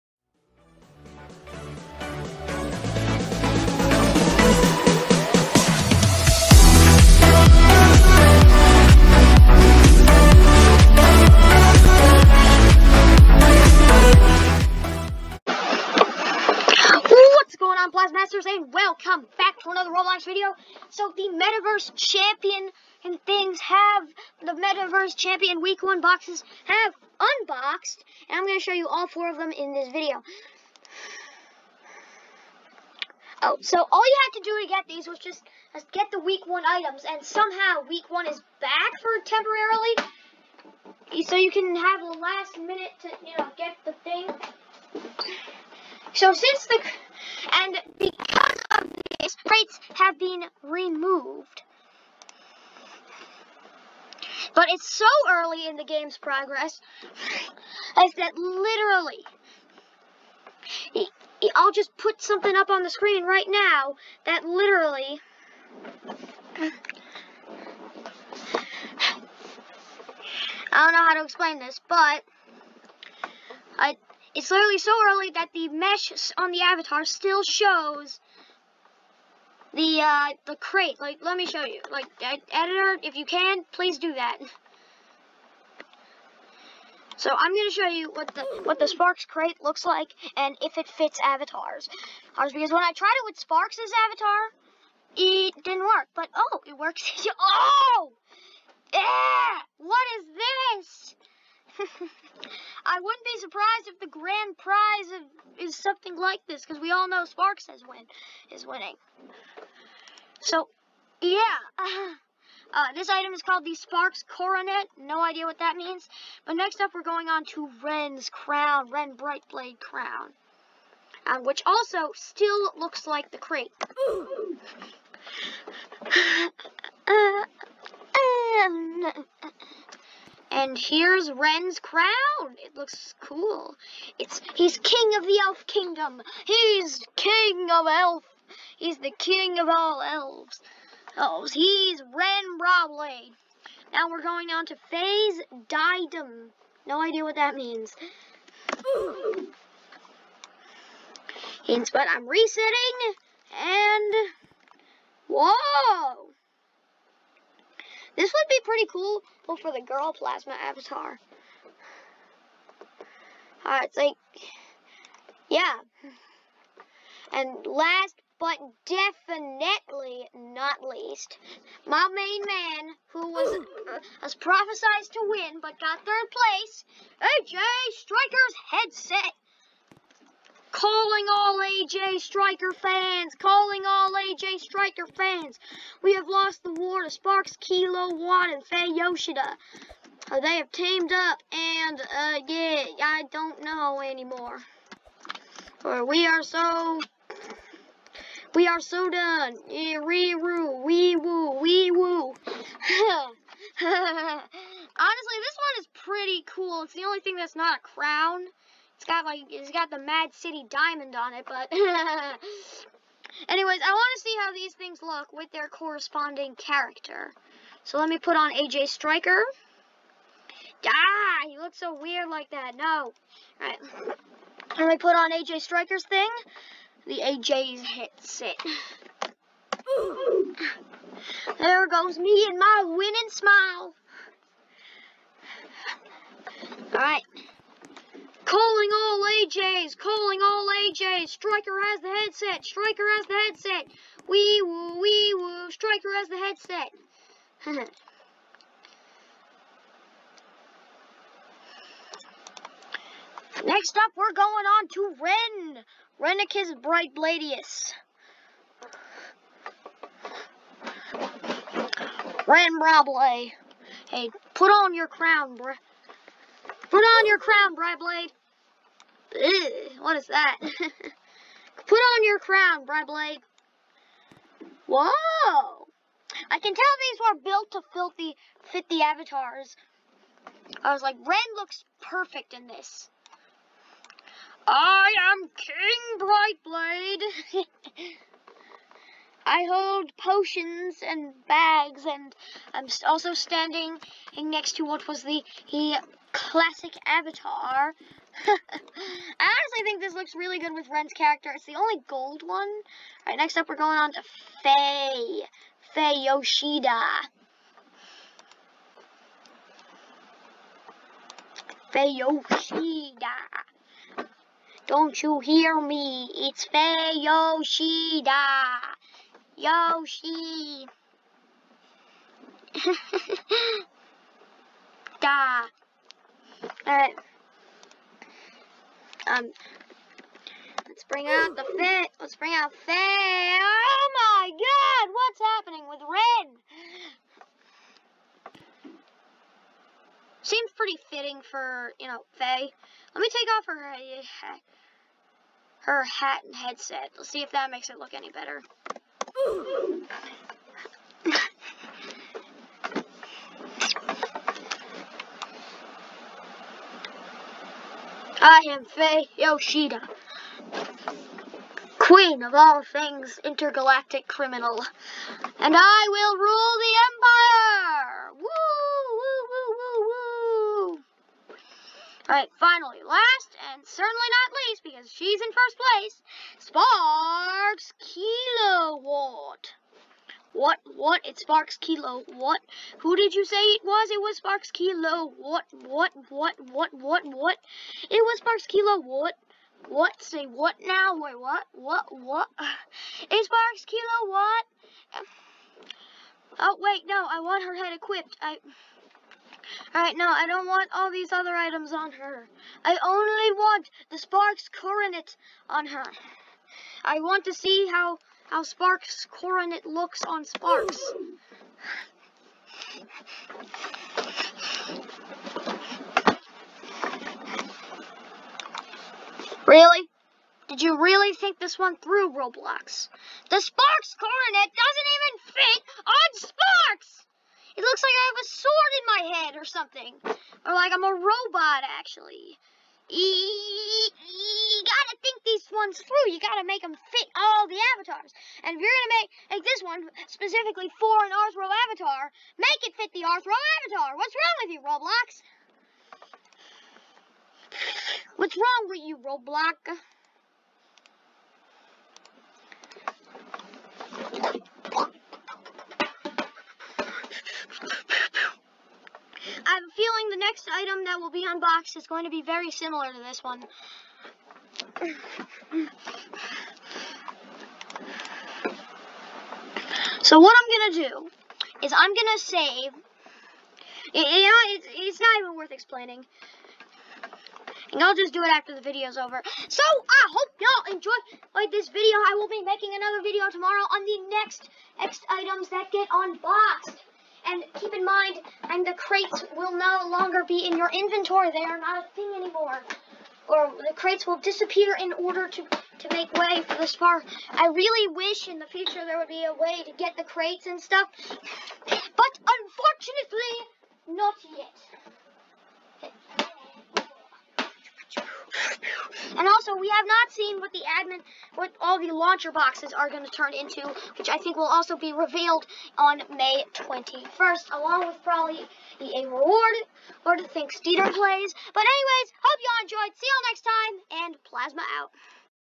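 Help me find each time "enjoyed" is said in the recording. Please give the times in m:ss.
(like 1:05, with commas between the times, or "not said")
8:00, 8:42.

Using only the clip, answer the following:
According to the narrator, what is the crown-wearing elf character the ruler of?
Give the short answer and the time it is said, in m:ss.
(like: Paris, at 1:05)
the elf kingdom, at 2:14.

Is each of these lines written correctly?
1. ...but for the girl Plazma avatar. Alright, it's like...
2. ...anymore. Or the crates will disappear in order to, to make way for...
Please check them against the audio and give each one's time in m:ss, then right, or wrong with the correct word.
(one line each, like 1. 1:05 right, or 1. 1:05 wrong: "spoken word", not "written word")
1. 2:39 right
2. 8:12 right.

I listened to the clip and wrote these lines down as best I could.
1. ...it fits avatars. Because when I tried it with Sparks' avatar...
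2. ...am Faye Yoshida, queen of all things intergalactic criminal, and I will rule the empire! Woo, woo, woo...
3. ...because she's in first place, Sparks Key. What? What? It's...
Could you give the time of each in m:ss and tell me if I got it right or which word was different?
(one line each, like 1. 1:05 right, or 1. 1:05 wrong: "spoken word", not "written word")
1. 1:30 right
2. 5:58 right
3. 6:14 right.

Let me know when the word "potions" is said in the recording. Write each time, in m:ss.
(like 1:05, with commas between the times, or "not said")
4:50.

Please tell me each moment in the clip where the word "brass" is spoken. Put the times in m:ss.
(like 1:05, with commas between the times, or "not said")
not said.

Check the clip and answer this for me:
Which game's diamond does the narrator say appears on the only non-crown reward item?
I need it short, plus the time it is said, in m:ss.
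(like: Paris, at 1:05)
Mad City, at 3:29.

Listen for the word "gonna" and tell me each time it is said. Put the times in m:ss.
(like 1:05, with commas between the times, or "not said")
1:27, 7:18.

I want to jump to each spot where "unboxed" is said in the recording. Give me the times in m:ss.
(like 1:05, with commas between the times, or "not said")
0:27, 7:41, 8:06.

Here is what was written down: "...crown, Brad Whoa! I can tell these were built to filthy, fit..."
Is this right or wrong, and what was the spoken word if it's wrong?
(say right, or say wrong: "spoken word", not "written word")
right.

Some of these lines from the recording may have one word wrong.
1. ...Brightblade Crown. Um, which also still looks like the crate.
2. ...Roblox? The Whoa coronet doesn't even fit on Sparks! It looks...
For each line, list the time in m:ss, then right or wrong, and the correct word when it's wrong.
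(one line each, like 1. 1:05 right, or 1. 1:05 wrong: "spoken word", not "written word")
1. 1:59 right
2. 7:02 wrong: "Sparks", not "Whoa".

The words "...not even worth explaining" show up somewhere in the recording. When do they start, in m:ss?
7:55.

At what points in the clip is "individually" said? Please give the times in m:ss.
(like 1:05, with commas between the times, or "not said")
not said.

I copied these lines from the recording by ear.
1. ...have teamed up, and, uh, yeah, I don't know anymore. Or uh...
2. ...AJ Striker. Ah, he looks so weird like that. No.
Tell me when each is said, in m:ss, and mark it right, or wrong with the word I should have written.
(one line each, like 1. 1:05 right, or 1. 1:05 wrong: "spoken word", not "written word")
1. 3:10 right
2. 3:38 right.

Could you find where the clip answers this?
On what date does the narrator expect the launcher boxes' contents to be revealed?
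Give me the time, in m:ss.
8:36.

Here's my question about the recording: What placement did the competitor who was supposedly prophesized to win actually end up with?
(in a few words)
third place.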